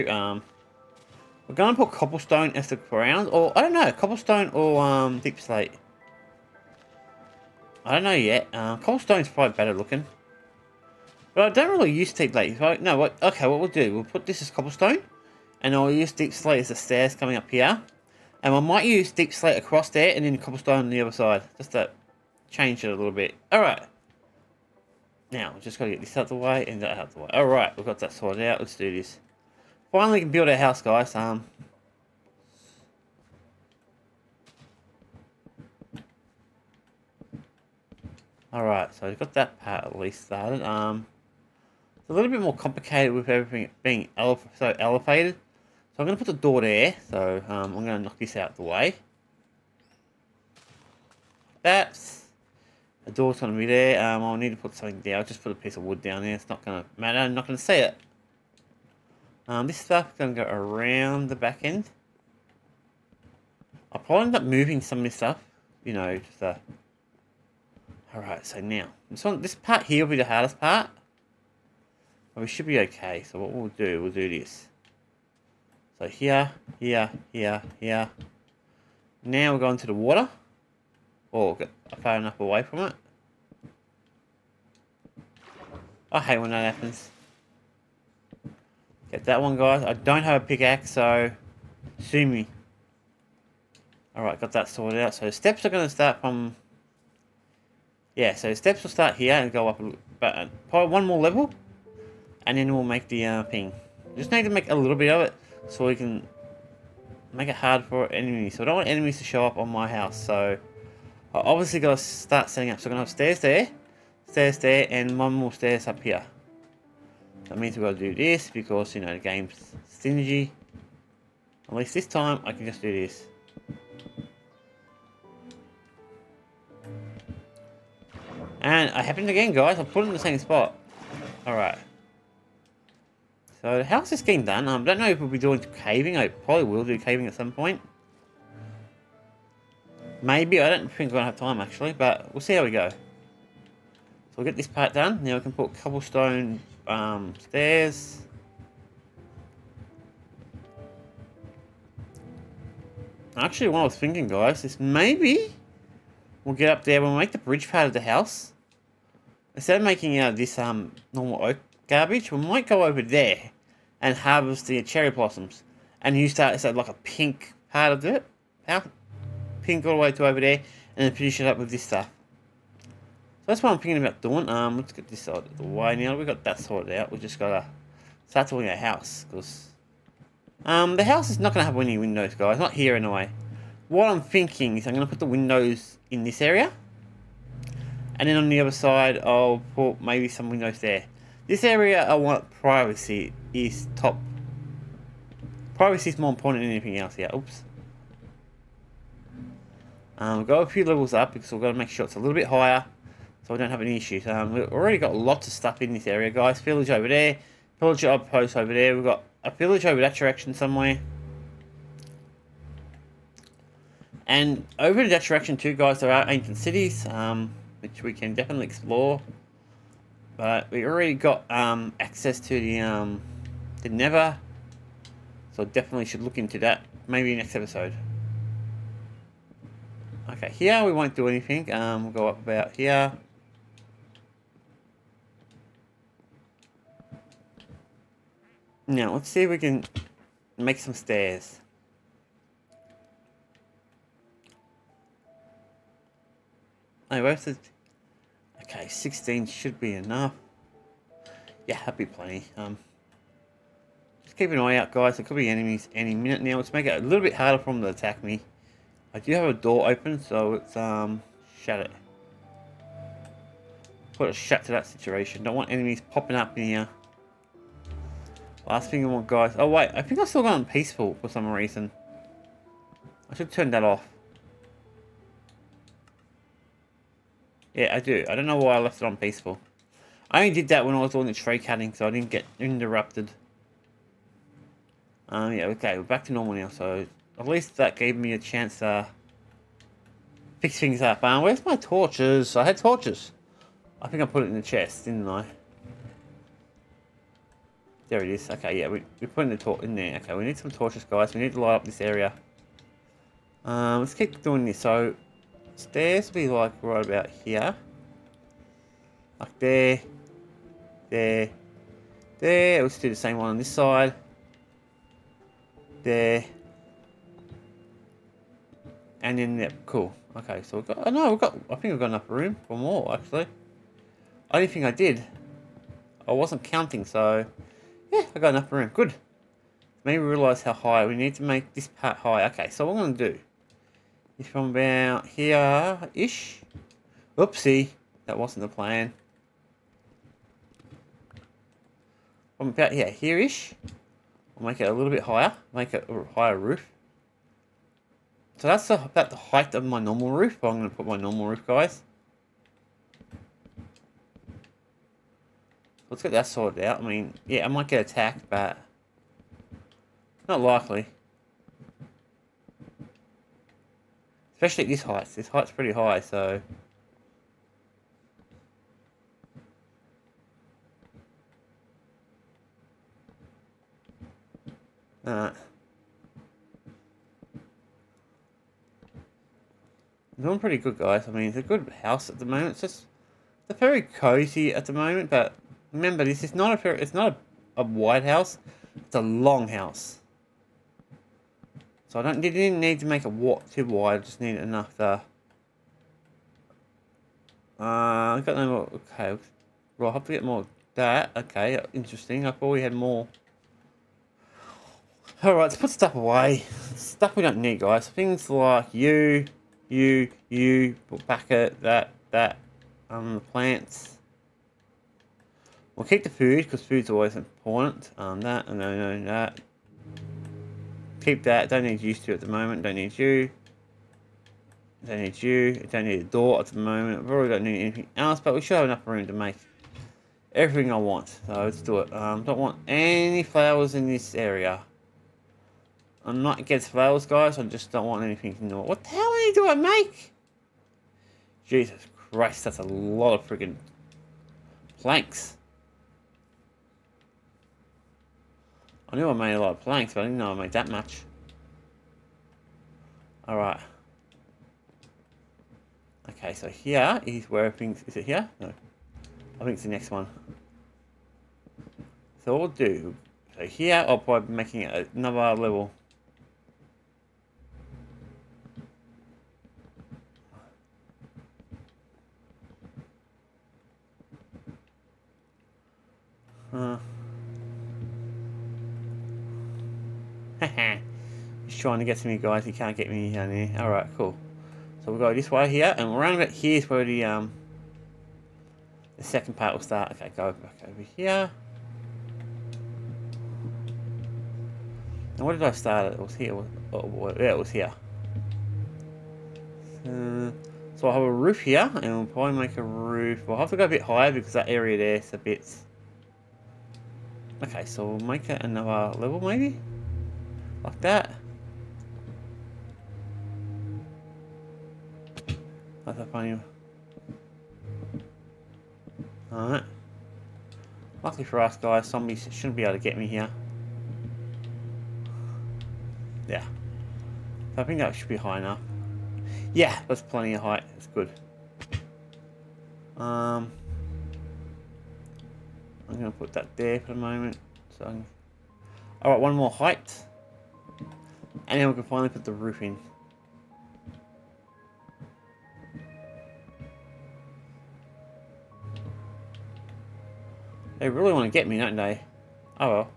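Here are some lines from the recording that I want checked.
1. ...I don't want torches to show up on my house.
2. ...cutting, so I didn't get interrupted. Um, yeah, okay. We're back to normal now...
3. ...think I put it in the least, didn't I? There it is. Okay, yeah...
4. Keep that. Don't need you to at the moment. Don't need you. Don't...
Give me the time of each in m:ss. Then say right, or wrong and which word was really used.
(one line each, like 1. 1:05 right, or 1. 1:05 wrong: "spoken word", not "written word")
1. 1:48 wrong: "enemies", not "torches"
2. 4:41 right
3. 4:54 wrong: "chest", not "least"
4. 7:01 right.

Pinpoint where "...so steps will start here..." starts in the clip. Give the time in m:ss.
1:38.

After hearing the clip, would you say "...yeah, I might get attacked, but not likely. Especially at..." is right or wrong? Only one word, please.
right.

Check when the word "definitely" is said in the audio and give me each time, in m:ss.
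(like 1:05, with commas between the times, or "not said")
3:38, 3:45.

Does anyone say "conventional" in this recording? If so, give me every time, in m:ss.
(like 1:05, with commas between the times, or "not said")
not said.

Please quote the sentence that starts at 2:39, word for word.
Instead of making out uh, this um normal oak garbage, we might go over there and harvest the cherry blossoms.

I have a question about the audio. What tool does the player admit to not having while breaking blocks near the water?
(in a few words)
A pickaxe.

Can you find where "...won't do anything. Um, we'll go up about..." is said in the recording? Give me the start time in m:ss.
3:50.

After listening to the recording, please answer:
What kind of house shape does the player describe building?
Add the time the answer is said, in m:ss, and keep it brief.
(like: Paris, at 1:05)
A long house, at 6:29.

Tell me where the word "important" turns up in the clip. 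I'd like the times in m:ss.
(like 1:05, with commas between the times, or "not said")
3:16, 6:57.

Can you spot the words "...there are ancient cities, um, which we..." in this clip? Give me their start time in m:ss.
3:36.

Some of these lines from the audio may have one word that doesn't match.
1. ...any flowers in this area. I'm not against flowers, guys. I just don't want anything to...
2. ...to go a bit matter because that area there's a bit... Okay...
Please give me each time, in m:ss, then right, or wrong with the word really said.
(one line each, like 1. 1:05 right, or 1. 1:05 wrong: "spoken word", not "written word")
1. 7:12 right
2. 8:23 wrong: "higher", not "matter".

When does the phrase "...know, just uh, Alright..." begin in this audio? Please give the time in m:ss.
1:05.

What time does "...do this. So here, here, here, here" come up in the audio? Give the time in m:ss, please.
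1:14.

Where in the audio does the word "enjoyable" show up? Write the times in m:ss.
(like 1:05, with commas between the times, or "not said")
not said.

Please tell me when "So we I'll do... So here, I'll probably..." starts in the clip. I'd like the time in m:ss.
7:42.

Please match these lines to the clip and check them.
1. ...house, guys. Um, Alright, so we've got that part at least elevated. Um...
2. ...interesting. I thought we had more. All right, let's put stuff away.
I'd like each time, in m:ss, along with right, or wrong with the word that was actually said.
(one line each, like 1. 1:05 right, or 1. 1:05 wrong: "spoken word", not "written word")
1. 0:30 wrong: "started", not "elevated"
2. 6:41 right.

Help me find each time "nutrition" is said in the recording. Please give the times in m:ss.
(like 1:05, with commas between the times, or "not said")
not said.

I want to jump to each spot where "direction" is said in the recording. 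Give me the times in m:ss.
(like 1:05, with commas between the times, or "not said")
3:30, 3:35.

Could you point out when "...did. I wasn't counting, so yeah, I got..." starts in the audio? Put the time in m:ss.
5:24.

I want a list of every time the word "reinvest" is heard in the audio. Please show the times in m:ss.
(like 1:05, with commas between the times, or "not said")
not said.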